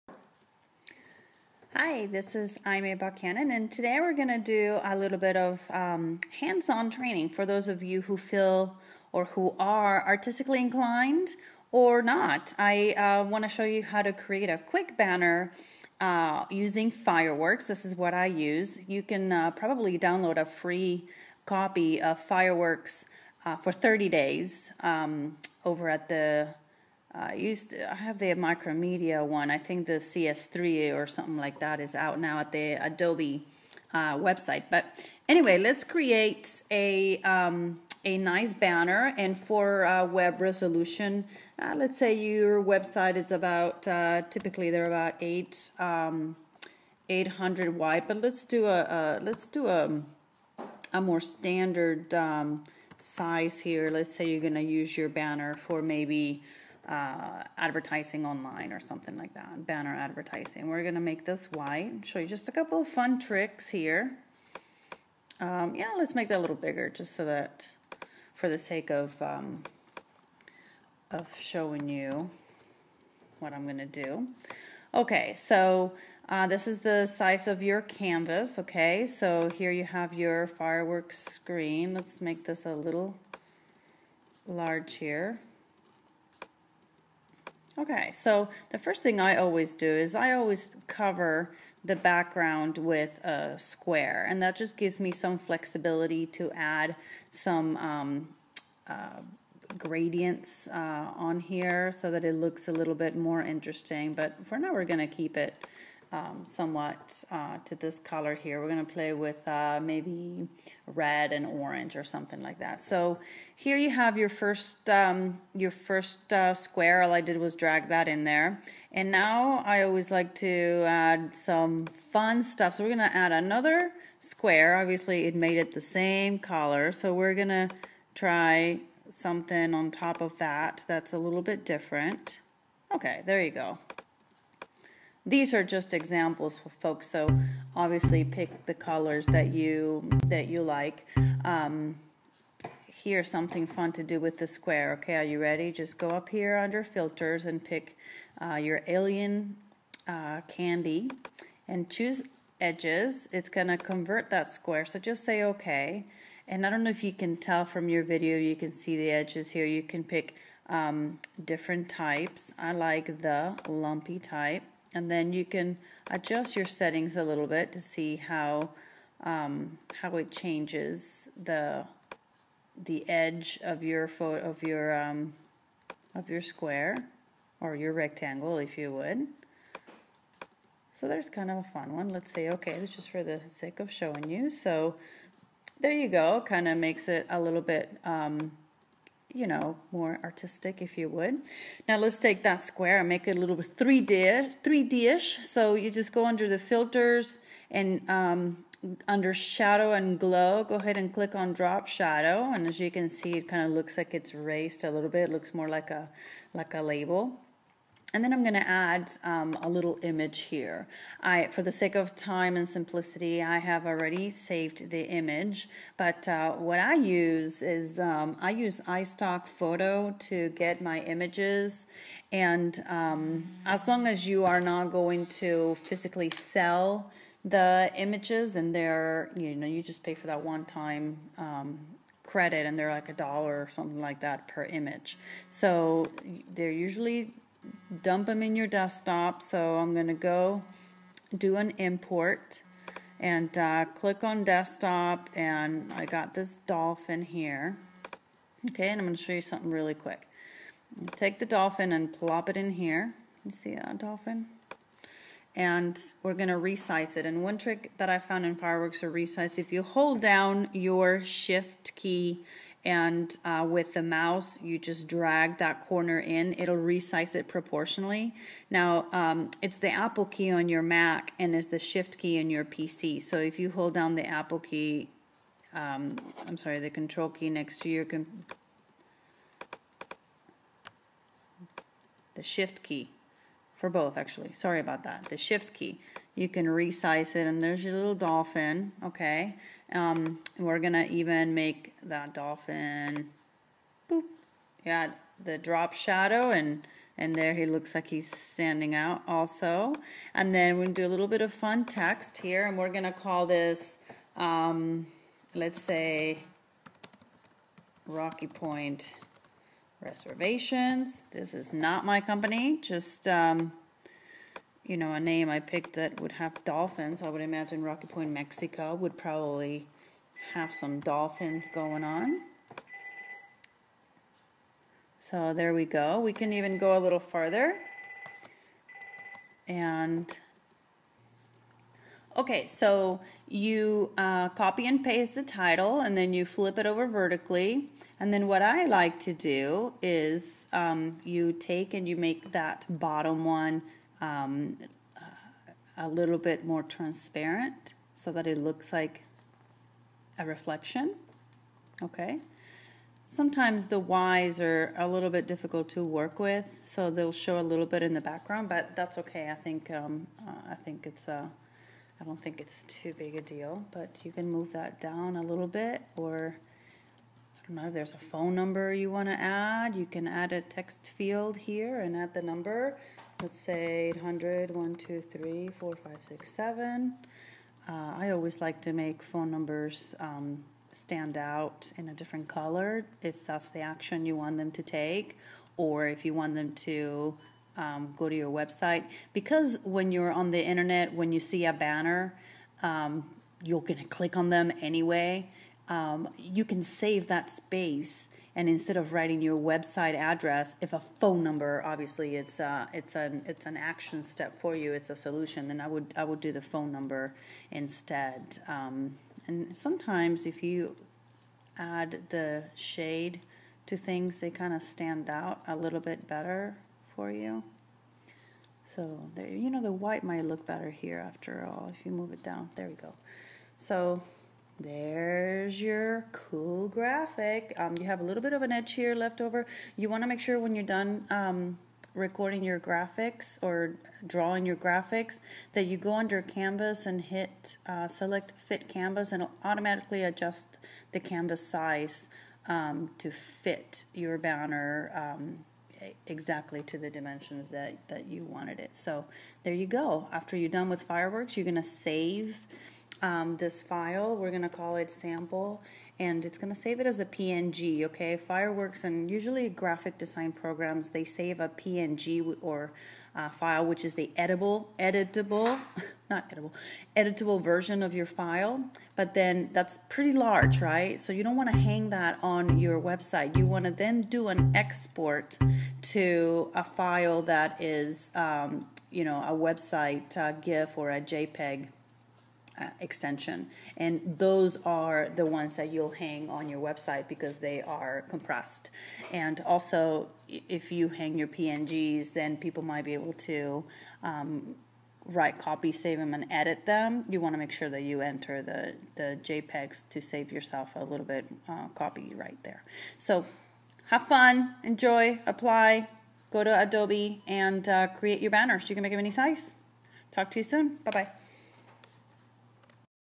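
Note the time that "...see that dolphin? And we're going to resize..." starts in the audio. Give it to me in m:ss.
4:13.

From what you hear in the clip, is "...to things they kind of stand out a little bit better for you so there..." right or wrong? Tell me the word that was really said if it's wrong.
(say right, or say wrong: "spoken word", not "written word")
right.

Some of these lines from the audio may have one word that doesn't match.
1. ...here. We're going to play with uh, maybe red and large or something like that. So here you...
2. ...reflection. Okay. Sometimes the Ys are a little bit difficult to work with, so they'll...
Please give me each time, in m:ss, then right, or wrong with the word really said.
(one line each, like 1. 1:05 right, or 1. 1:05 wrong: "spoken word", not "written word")
1. 1:48 wrong: "orange", not "large"
2. 5:50 right.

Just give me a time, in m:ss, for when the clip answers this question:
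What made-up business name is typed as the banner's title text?
5:08.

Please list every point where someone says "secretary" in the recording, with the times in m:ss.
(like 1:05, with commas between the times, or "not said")
not said.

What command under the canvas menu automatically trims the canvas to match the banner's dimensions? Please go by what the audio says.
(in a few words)
Fit canvas.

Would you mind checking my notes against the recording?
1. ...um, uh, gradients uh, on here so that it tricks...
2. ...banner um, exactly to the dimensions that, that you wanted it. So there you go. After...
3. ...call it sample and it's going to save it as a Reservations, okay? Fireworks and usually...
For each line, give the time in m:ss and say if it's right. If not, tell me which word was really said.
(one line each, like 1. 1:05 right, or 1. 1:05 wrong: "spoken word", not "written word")
1. 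1:37 wrong: "looks", not "tricks"
2. 7:24 right
3. 7:34 wrong: "PNG", not "Reservations".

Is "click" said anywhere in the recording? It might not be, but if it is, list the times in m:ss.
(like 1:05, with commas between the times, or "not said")
3:21, 4:03, 6:34.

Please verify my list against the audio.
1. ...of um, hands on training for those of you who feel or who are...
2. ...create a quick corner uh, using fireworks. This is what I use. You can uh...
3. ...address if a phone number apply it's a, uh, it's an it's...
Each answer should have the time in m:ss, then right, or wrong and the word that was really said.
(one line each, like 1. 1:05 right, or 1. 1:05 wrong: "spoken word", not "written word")
1. 0:05 right
2. 0:14 wrong: "banner", not "corner"
3. 6:40 wrong: "obviously", not "apply".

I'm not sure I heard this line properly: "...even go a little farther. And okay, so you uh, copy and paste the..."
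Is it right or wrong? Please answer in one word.
right.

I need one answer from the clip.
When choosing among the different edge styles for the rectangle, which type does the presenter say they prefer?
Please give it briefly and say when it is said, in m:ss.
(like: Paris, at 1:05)
Lumpy, at 2:43.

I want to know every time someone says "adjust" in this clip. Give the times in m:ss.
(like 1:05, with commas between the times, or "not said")
2:46, 7:20.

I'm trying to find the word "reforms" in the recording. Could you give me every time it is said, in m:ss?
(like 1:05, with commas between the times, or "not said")
not said.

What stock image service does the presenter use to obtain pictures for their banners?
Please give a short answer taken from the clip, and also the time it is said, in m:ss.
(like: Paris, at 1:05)
iStock Photo, at 3:38.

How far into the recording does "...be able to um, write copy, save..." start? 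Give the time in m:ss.
8:13.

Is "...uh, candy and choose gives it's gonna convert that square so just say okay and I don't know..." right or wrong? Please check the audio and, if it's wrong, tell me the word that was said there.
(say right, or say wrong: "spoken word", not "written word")
wrong: "edges", not "gives".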